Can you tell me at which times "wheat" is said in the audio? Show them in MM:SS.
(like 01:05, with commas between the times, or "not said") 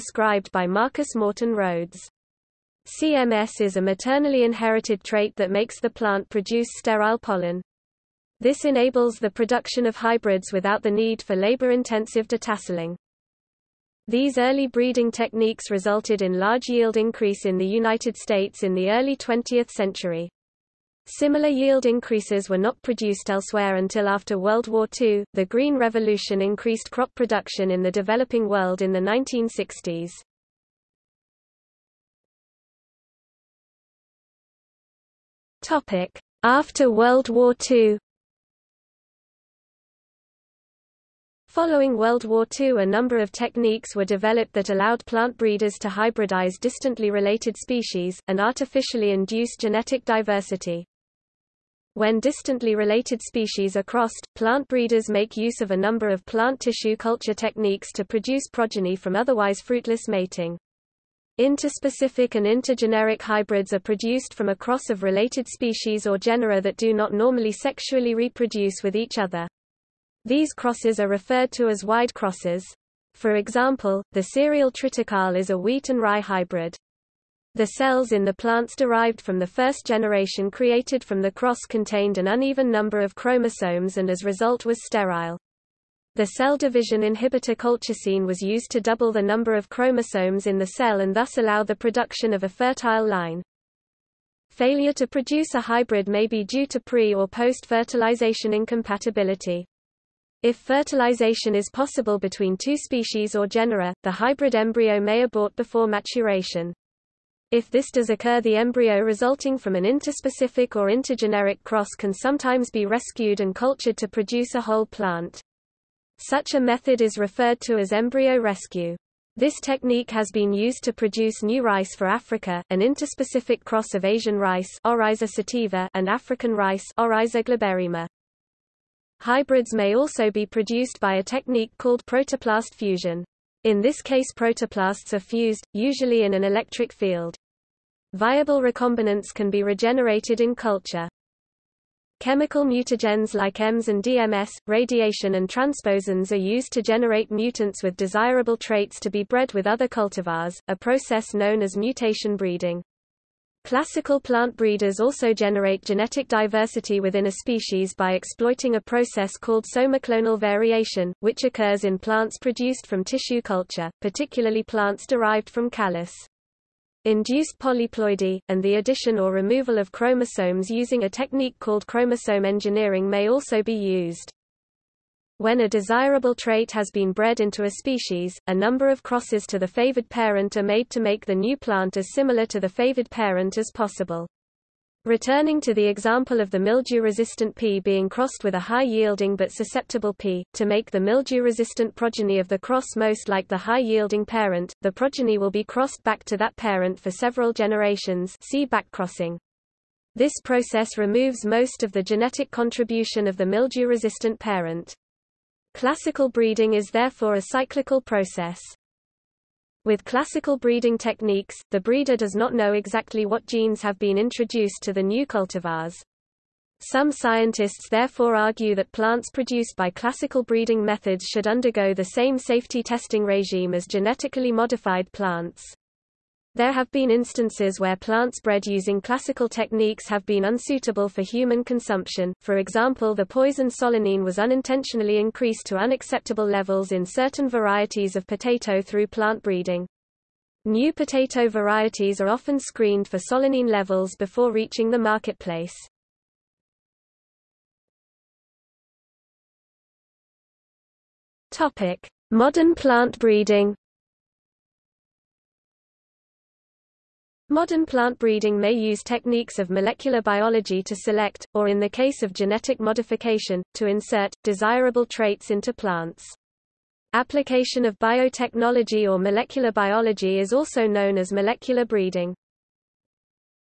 01:15.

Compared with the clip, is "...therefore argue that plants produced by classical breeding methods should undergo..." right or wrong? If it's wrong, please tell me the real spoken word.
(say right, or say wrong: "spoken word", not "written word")
right.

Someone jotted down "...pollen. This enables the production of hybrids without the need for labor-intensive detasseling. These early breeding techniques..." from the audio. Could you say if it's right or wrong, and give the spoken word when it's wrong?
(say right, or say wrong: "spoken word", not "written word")
right.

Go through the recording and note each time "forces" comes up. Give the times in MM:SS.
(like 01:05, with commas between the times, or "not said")
not said.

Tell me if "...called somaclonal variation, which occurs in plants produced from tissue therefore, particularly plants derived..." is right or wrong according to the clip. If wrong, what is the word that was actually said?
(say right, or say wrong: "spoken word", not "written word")
wrong: "culture", not "therefore".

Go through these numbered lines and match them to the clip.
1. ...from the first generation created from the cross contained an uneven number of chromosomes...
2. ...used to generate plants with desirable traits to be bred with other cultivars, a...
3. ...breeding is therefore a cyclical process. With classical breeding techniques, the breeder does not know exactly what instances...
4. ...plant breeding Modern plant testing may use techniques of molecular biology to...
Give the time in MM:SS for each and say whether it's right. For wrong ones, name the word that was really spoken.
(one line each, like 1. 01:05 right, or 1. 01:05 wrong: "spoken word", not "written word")
1. 01:19 right
2. 02:26 wrong: "mutants", not "plants"
3. 03:26 wrong: "genes", not "instances"
4. 04:12 wrong: "breeding", not "testing".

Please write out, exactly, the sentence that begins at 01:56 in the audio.
Such a method is referred to as embryo rescue.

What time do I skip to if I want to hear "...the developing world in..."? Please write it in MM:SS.
00:27.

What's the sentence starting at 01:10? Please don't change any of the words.
These crosses are referred to as wide crosses.